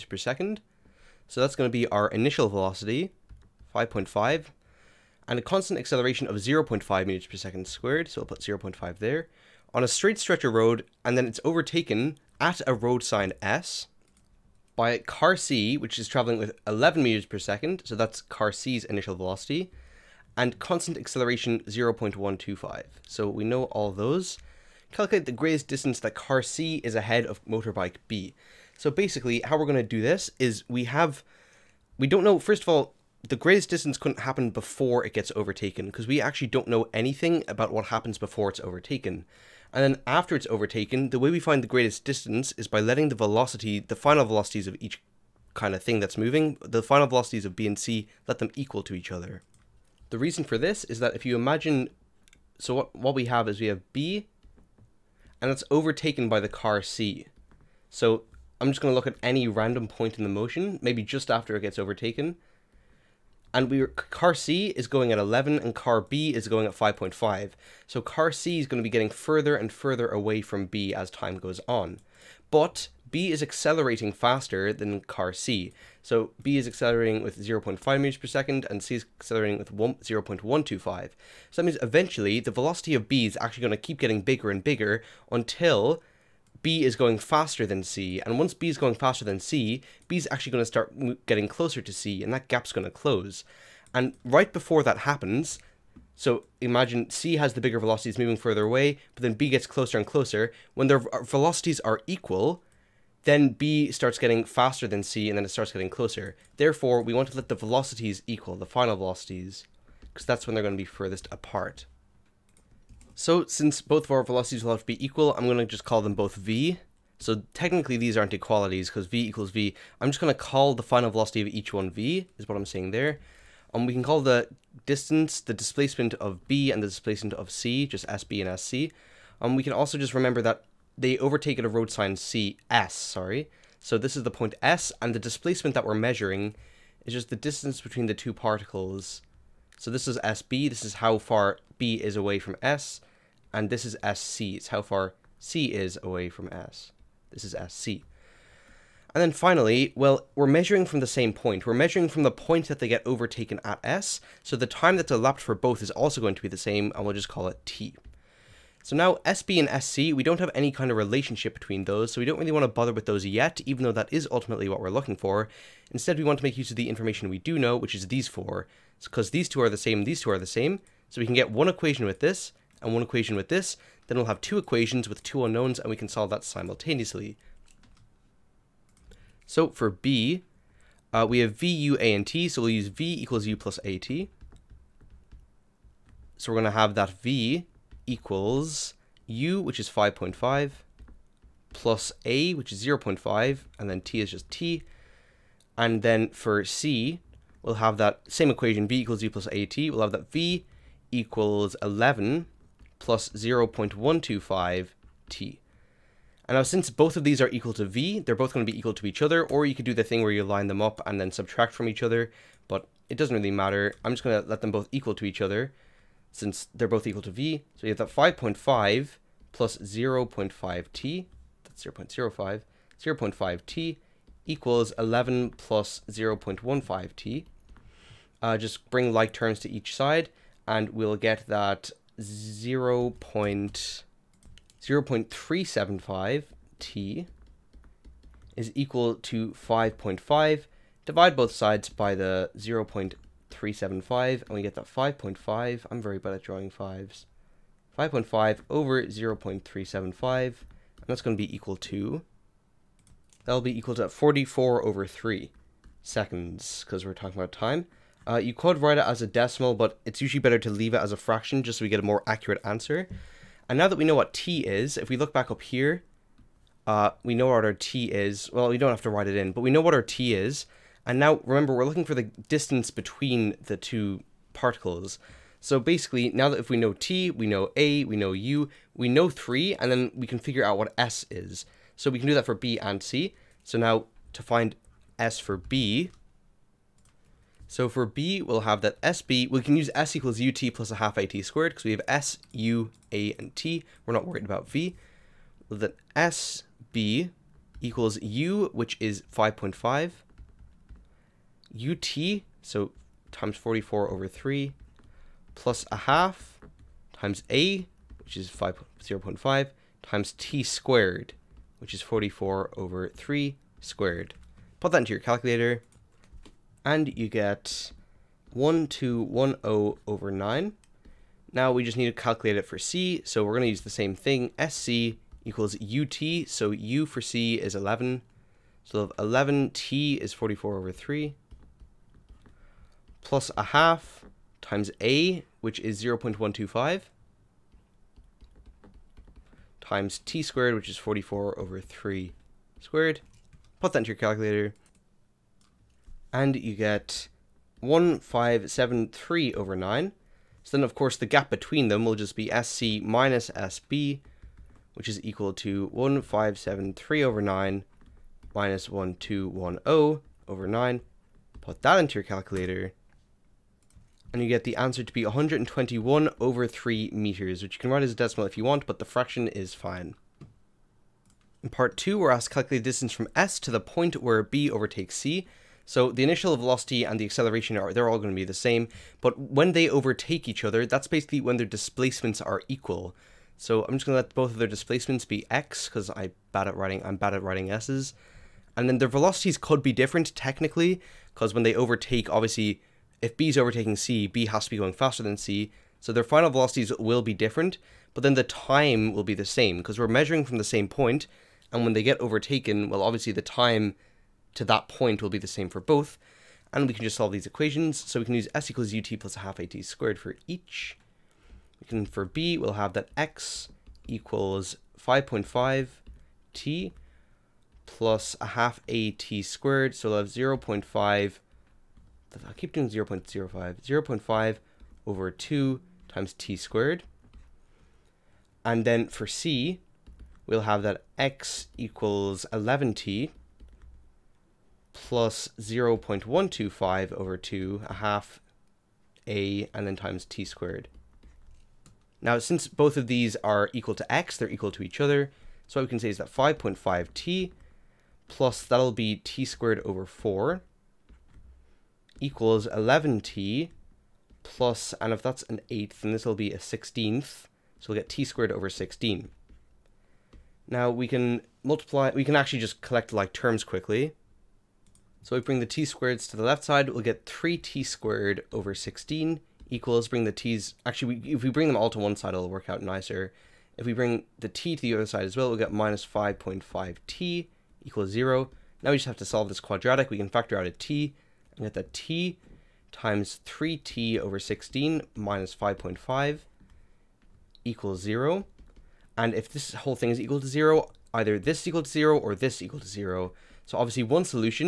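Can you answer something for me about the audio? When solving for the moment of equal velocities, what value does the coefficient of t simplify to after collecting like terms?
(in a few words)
0.375.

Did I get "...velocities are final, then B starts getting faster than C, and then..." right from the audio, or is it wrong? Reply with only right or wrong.
wrong.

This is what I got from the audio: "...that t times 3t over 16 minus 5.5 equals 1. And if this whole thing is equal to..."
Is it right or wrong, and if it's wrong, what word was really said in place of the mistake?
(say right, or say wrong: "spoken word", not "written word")
wrong: "0", not "1".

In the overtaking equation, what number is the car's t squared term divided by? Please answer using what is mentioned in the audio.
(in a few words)
16.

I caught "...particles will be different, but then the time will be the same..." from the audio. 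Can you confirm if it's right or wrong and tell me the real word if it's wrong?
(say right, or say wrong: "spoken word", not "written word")
wrong: "velocities", not "particles".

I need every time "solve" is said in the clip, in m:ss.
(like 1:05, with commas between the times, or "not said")
2:56, 6:47, 7:59.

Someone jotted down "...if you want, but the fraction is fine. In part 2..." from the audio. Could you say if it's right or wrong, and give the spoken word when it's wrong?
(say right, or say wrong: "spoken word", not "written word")
right.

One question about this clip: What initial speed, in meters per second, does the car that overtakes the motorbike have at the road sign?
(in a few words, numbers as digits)
11.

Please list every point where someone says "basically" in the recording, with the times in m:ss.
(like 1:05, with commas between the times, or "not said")
0:28, 4:35, 6:21.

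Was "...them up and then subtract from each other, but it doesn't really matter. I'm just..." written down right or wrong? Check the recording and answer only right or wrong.
right.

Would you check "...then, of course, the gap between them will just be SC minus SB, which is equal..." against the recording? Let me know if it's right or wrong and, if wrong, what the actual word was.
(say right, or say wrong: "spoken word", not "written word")
right.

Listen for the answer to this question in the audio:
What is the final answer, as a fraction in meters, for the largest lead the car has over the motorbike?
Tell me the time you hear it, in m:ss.
6:05.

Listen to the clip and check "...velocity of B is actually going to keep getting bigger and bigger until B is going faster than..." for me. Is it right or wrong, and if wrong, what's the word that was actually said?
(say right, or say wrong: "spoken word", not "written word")
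right.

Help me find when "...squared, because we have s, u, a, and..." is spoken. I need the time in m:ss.
4:51.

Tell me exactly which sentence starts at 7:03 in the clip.
0 0.5 over 2 times t squared.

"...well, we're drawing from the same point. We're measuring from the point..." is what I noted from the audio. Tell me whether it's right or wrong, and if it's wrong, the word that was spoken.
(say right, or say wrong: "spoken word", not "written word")
wrong: "measuring", not "drawing".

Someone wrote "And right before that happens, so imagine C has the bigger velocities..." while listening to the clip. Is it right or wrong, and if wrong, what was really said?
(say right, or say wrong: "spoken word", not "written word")
right.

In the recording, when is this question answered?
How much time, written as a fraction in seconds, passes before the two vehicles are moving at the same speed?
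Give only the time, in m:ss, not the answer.
4:14.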